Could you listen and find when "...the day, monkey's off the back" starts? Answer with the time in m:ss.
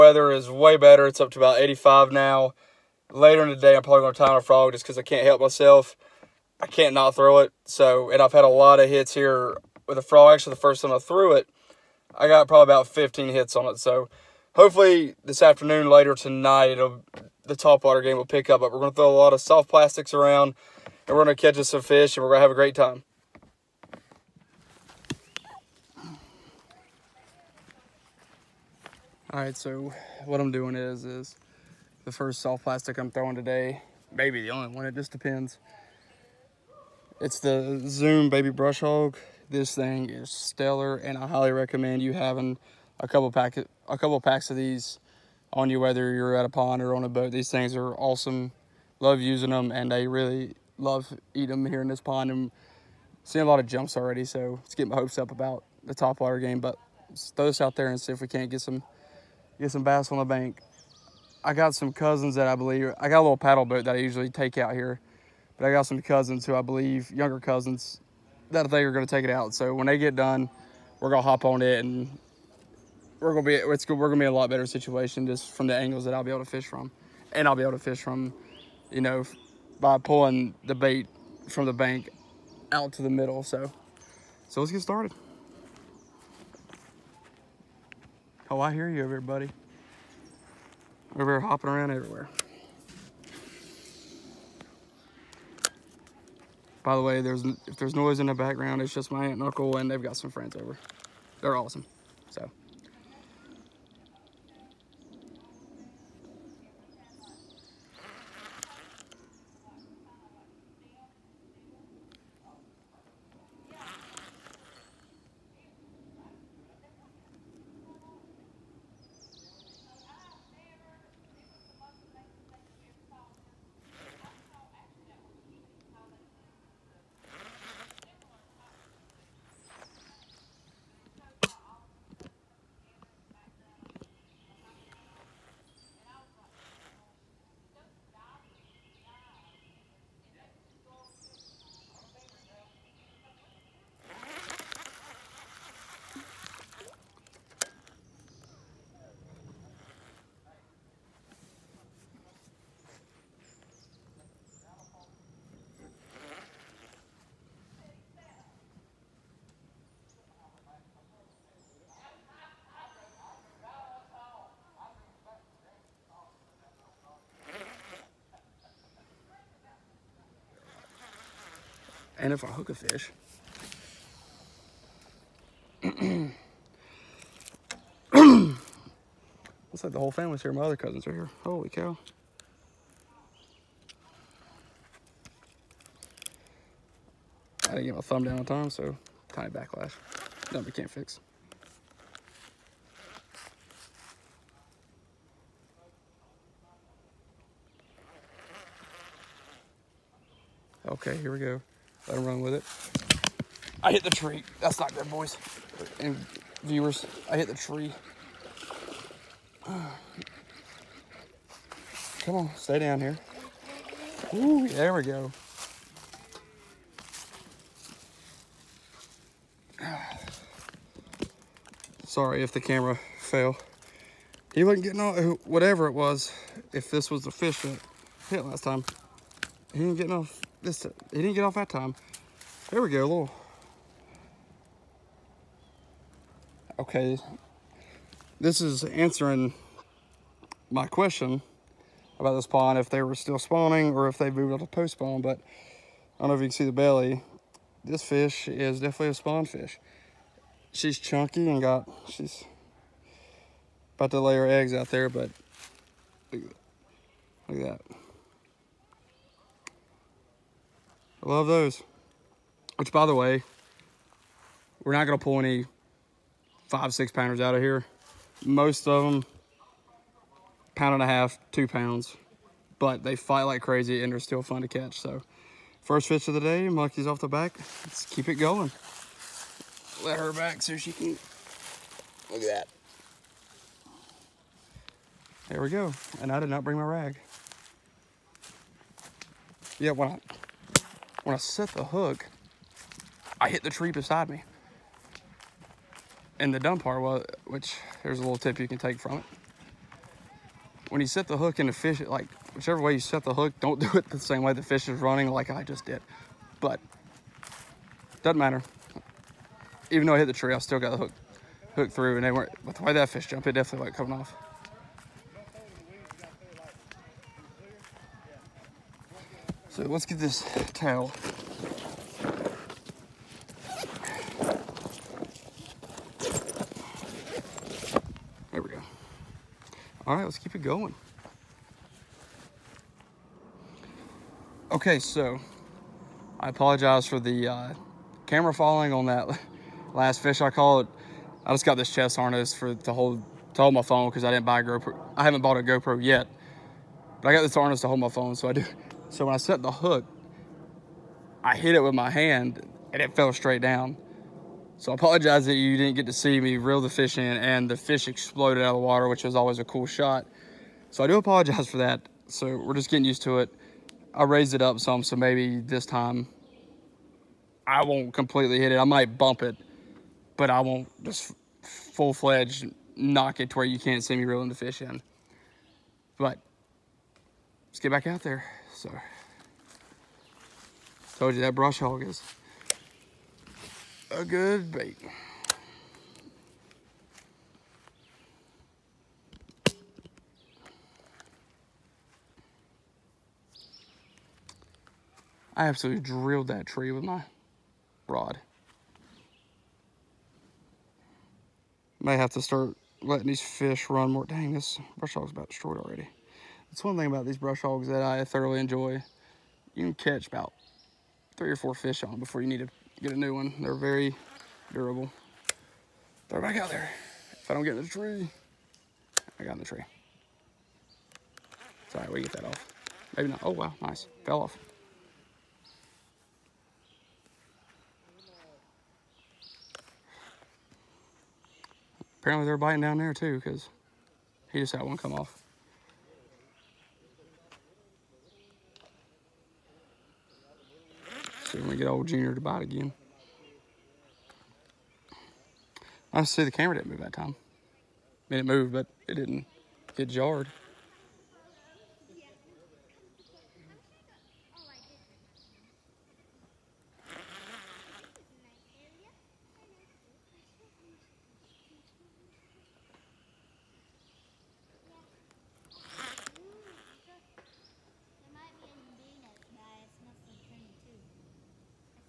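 4:36.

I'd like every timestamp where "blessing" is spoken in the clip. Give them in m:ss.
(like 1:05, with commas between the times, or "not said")
not said.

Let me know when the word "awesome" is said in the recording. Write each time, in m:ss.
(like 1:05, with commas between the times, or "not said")
0:47, 1:41.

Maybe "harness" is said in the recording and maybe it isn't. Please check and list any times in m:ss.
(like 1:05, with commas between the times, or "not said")
5:42, 5:47.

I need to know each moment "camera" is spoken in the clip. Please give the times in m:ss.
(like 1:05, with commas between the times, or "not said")
3:42, 5:38, 7:26.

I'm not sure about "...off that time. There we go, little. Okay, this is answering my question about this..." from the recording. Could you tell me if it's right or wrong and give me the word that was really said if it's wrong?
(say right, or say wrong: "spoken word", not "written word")
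right.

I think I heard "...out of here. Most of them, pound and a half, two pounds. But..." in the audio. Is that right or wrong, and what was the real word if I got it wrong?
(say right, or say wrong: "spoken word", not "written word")
right.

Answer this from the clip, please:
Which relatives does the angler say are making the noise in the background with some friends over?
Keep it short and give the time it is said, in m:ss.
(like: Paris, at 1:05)
Aunt and Uncle, at 1:39.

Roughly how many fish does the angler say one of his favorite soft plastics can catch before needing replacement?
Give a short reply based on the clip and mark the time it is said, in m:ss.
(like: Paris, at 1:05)
3 or 4, at 6:51.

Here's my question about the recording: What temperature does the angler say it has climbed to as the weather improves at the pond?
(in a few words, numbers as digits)
85.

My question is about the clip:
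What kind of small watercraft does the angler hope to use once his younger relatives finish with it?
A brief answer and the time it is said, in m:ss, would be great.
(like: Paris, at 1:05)
paddle boat, at 1:03.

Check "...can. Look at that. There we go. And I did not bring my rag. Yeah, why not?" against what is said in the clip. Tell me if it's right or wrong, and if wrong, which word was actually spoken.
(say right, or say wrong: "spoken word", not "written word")
right.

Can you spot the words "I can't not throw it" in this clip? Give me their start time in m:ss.
0:06.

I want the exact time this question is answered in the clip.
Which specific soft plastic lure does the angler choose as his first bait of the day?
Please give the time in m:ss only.
0:37.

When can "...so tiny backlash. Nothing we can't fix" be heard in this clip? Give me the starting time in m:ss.
3:08.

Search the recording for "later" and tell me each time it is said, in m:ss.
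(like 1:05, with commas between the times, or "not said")
0:03, 0:15.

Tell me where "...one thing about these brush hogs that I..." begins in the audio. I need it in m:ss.
6:46.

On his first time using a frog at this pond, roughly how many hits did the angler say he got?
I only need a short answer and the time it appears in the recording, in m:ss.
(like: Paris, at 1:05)
15, at 0:12.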